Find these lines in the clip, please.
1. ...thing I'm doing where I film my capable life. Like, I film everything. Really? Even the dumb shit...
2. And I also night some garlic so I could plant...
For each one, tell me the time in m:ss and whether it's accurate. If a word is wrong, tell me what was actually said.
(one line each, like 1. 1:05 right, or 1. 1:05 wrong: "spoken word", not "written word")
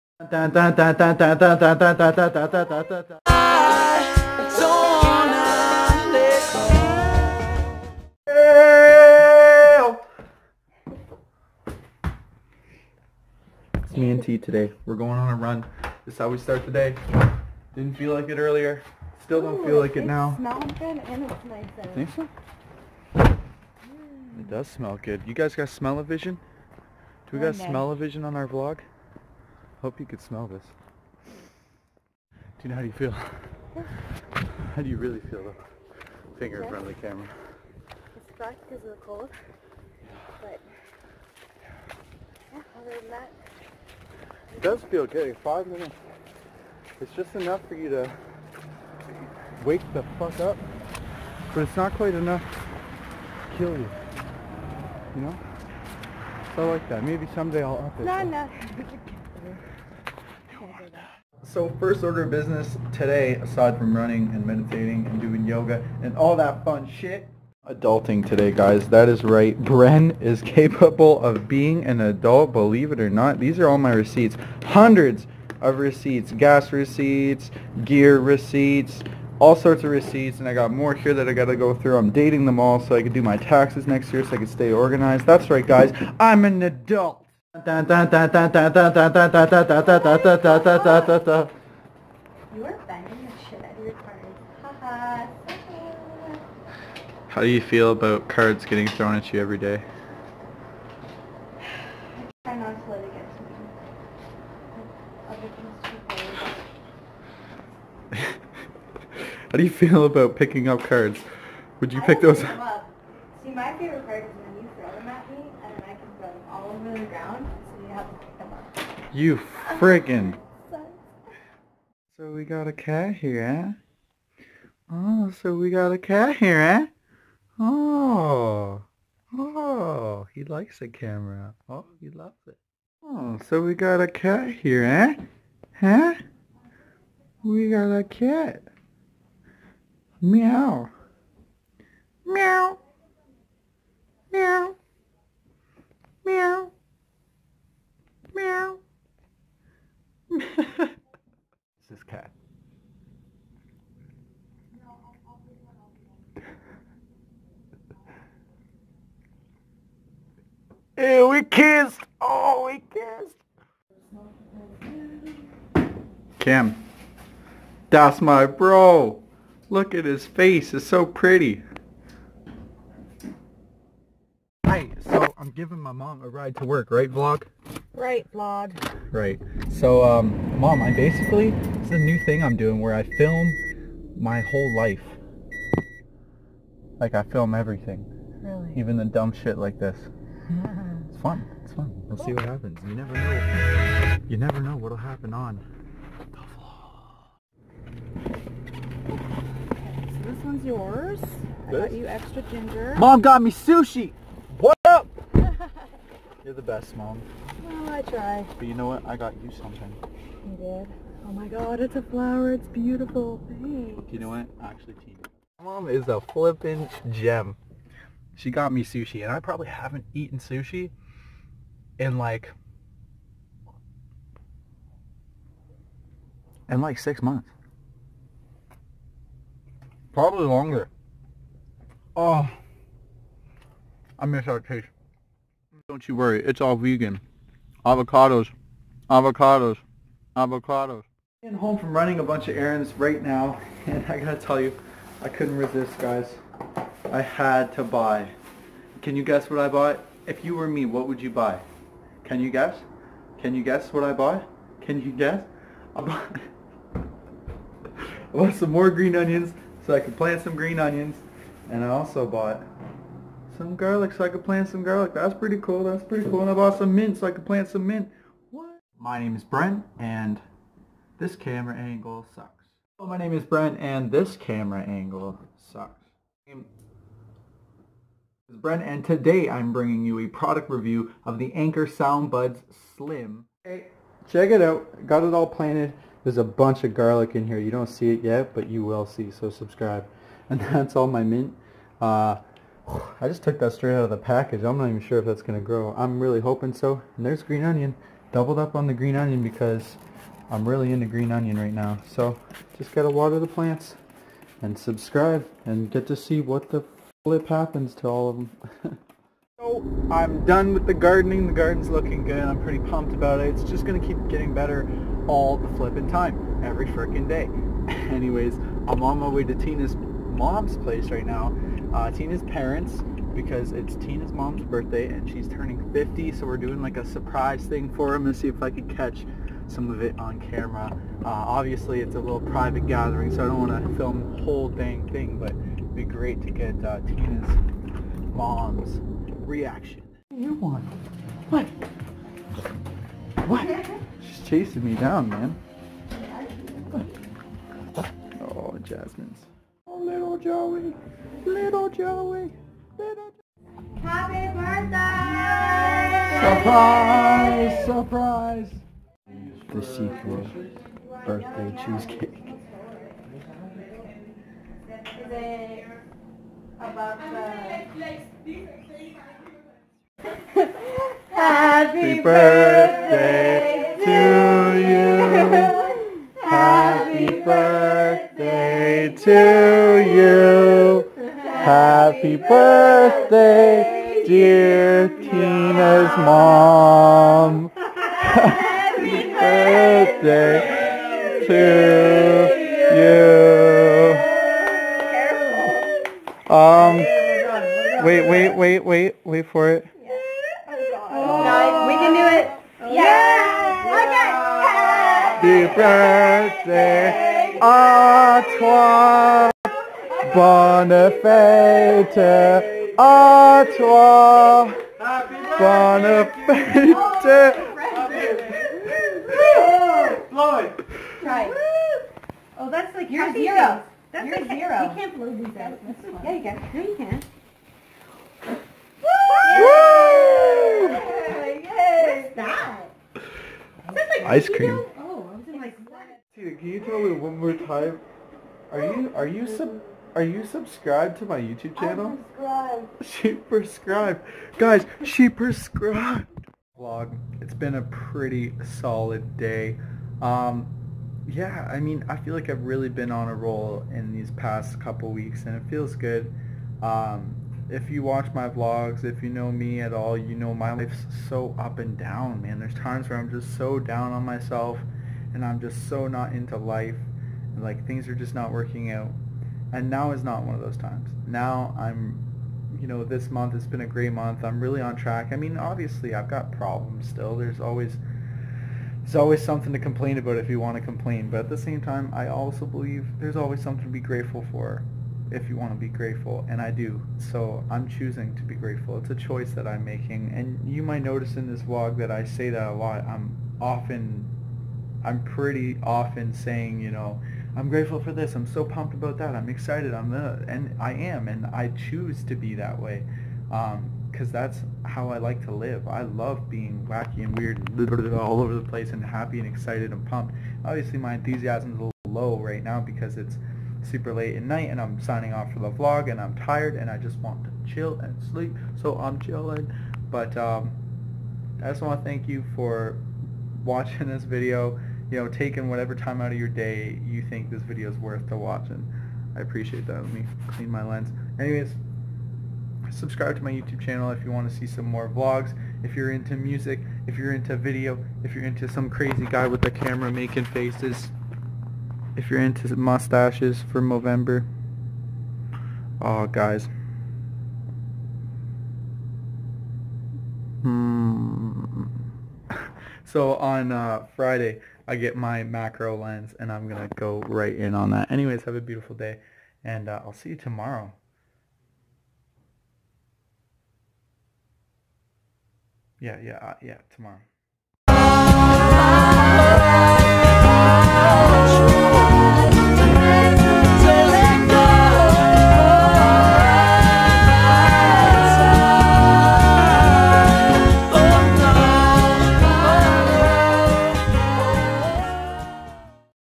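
1. 3:02 wrong: "whole", not "capable"
2. 4:21 wrong: "bought", not "night".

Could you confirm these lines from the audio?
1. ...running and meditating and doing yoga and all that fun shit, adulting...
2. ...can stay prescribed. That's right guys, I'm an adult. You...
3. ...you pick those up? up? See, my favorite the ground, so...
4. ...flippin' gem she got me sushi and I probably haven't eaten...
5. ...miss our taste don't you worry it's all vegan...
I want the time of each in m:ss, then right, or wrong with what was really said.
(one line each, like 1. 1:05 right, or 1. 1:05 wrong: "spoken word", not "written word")
1. 1:03 right
2. 1:24 wrong: "organized", not "prescribed"
3. 1:51 right
4. 3:36 right
5. 3:54 right.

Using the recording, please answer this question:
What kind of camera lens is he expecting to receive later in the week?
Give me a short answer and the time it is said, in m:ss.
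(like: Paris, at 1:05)
Macro lens, at 9:15.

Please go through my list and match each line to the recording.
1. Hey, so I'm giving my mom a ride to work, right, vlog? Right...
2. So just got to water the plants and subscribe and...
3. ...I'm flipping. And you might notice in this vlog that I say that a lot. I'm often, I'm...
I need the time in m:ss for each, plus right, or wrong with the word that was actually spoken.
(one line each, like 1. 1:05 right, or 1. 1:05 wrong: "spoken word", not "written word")
1. 2:54 right
2. 5:02 right
3. 8:09 wrong: "making", not "flipping".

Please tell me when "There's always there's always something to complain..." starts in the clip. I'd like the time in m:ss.
7:57.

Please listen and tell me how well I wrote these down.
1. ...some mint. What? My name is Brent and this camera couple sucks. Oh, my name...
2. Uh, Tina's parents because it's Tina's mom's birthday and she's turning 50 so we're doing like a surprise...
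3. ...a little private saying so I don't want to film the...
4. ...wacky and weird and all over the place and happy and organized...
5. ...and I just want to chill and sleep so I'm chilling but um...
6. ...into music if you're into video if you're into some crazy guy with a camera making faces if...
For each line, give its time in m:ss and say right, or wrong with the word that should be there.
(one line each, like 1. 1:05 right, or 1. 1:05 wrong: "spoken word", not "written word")
1. 4:27 wrong: "angle", not "couple"
2. 5:21 right
3. 5:32 wrong: "gathering", not "saying"
4. 8:26 wrong: "excited", not "organized"
5. 8:36 right
6. 8:56 right.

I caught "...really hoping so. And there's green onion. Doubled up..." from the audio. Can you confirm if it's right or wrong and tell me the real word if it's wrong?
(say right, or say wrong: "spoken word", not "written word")
right.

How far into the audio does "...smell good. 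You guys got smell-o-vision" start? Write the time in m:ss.
0:24.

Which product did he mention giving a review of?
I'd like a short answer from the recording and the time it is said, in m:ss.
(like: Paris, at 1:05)
Anker Soundbuds Slim, at 4:41.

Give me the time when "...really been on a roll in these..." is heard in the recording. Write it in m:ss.
7:32.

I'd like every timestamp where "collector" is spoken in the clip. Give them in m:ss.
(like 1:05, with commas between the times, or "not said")
not said.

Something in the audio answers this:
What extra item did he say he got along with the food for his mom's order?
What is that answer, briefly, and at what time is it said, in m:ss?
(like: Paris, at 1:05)
Ginger, at 3:22.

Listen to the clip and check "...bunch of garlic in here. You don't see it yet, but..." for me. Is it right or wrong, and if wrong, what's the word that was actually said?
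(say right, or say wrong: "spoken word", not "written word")
right.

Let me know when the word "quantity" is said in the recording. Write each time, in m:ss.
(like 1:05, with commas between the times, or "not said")
not said.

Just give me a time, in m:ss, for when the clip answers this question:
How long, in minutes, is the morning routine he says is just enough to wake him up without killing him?
0:45.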